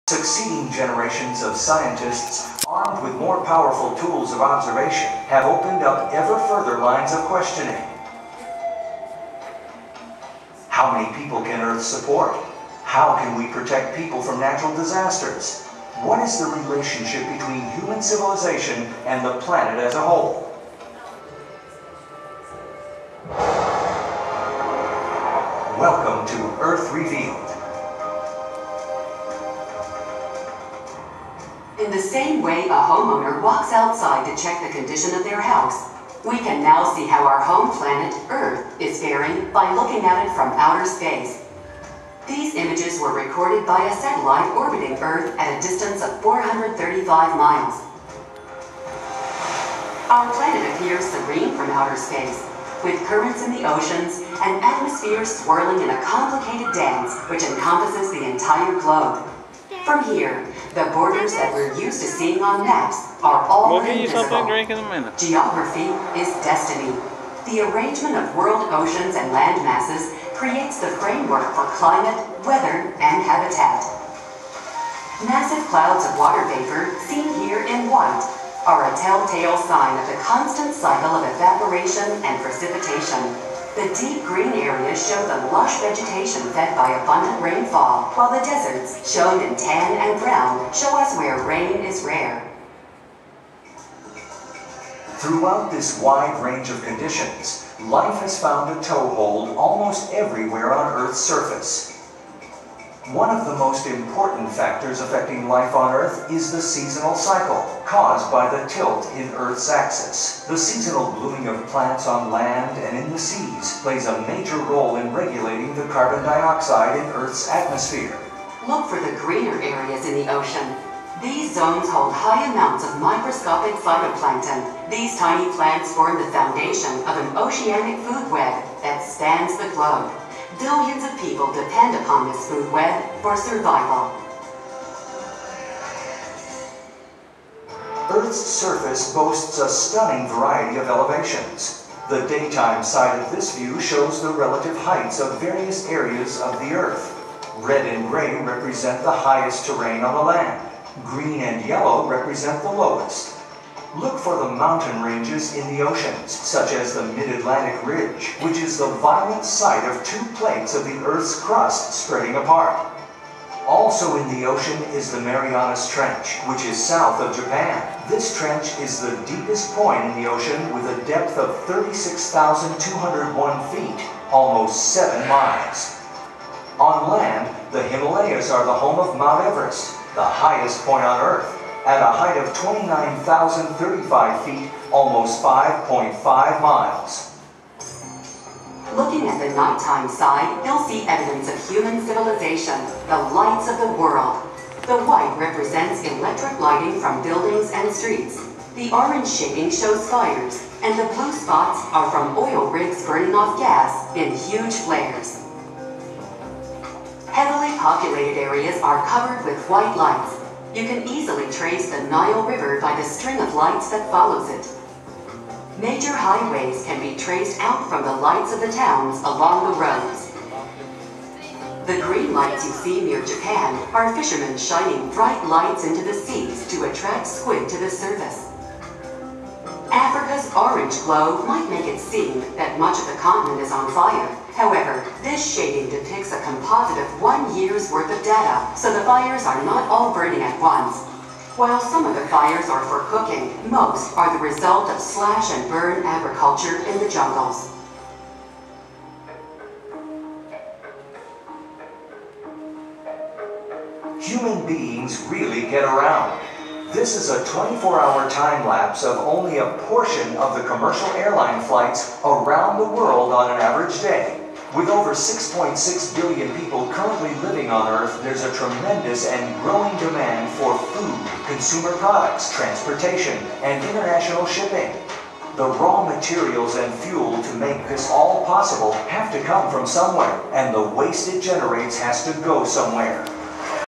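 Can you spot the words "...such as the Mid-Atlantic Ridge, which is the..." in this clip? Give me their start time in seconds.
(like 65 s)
156 s.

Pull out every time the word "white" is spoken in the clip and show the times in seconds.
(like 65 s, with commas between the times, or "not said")
77 s, 195 s, 209 s.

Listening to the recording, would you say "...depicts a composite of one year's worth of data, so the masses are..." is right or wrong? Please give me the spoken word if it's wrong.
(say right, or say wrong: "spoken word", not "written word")
wrong: "fires", not "masses".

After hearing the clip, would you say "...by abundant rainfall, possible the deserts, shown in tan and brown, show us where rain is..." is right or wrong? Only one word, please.
wrong.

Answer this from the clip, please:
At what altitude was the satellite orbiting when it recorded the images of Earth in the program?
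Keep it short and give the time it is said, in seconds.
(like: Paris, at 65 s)
435 miles, at 46 s.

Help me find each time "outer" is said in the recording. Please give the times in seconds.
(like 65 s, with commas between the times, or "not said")
40 s, 51 s.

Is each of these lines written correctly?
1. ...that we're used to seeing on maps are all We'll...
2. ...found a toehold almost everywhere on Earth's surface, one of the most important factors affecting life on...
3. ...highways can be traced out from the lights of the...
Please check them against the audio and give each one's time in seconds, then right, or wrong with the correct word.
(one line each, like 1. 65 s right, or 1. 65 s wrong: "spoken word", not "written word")
1. 61 s right
2. 98 s right
3. 216 s right.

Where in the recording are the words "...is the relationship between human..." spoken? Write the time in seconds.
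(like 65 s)
16 s.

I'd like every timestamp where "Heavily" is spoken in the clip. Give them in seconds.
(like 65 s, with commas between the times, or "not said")
207 s.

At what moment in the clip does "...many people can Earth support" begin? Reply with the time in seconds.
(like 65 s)
10 s.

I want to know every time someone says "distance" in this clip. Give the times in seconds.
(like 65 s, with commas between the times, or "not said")
45 s.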